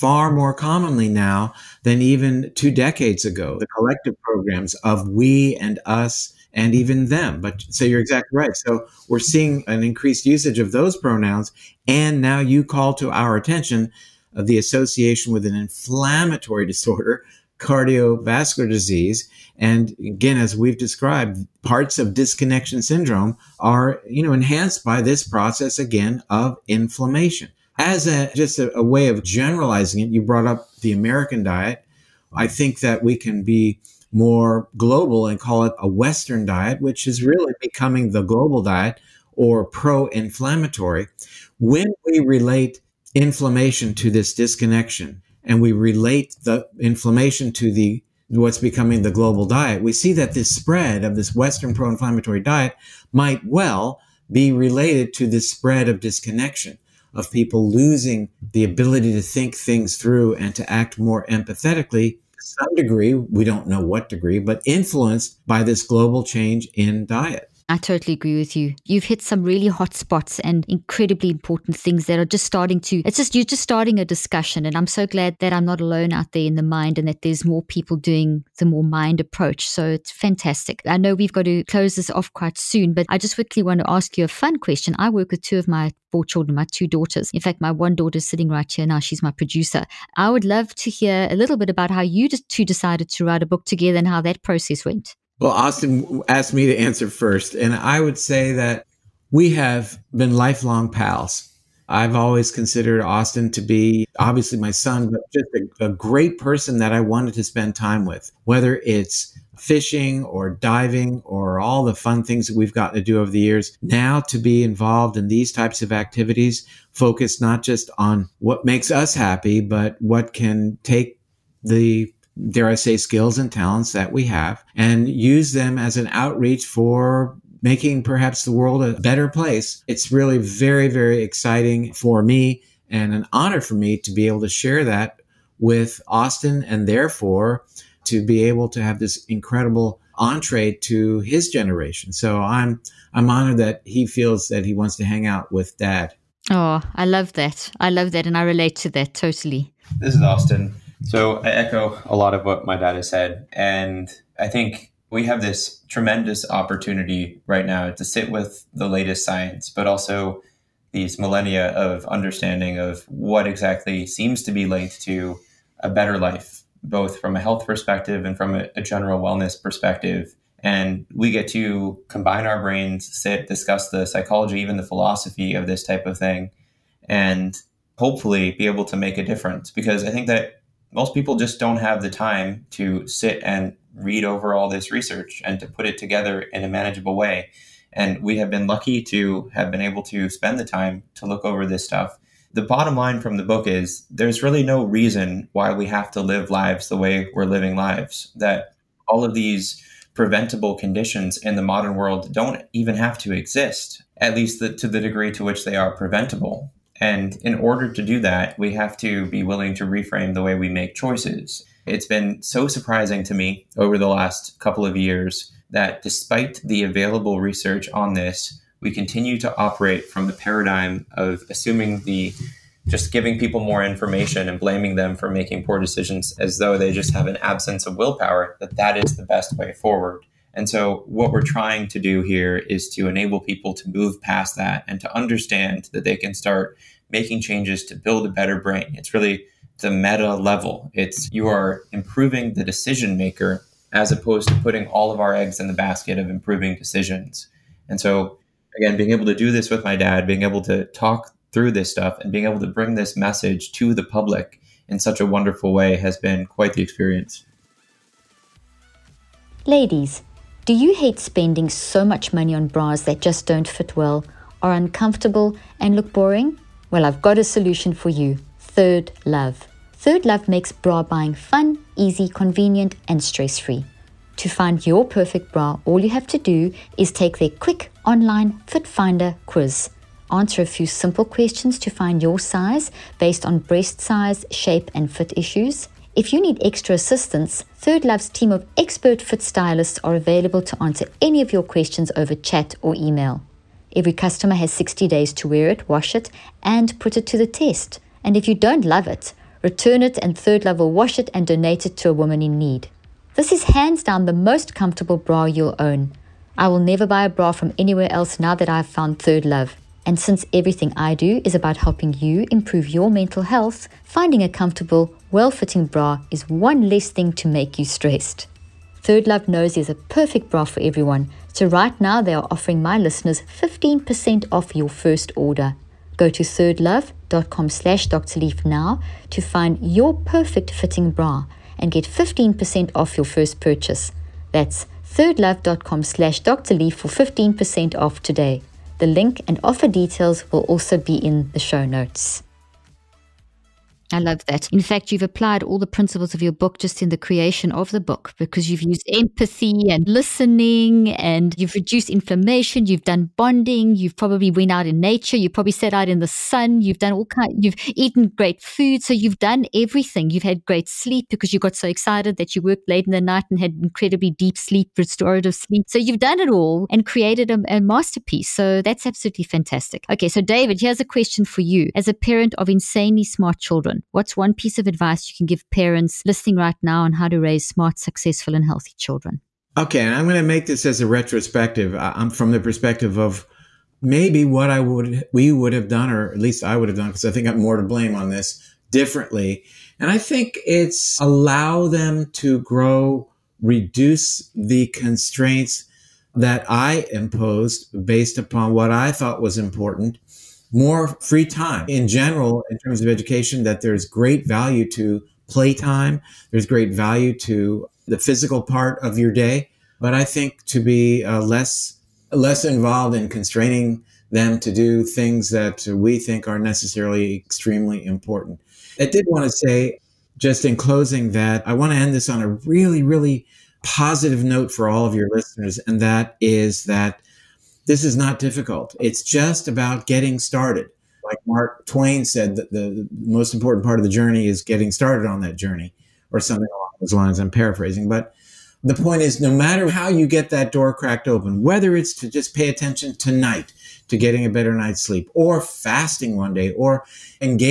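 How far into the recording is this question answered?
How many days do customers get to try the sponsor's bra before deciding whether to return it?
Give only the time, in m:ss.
4:54.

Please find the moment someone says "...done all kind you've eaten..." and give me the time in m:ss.
5:56.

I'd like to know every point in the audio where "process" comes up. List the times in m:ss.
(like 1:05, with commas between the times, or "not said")
0:25, 1:34.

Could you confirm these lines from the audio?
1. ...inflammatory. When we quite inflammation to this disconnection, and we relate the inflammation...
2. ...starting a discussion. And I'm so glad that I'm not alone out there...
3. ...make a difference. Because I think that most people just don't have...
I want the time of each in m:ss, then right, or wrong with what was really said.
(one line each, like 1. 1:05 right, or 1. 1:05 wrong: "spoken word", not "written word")
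1. 0:40 wrong: "relate", not "quite"
2. 1:13 right
3. 2:58 right.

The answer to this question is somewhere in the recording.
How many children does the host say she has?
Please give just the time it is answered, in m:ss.
1:26.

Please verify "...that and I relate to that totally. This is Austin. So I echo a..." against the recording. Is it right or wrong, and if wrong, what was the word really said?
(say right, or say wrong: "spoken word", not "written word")
right.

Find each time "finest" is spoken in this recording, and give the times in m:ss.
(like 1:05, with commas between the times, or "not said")
not said.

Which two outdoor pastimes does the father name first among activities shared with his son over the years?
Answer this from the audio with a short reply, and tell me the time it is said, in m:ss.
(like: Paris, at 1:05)
fishing or diving, at 1:49.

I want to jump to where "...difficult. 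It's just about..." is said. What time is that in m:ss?
7:08.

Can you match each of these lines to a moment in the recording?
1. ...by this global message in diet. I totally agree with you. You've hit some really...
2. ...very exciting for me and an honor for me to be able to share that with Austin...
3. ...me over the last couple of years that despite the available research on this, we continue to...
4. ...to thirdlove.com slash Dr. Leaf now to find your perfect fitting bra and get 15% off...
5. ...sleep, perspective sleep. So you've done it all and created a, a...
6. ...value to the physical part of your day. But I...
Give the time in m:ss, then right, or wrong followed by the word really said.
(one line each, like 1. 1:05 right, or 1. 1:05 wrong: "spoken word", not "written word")
1. 1:05 wrong: "change", not "message"
2. 2:10 right
3. 3:33 right
4. 5:26 right
5. 6:04 wrong: "restorative", not "perspective"
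6. 6:46 right.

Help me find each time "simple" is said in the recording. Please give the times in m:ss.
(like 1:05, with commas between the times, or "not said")
4:40.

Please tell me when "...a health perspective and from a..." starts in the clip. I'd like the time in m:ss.
2:47.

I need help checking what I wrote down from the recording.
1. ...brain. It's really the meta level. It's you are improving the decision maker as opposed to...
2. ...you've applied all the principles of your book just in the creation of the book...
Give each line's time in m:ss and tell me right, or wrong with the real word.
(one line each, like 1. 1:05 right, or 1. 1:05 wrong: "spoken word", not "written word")
1. 3:58 right
2. 5:45 right.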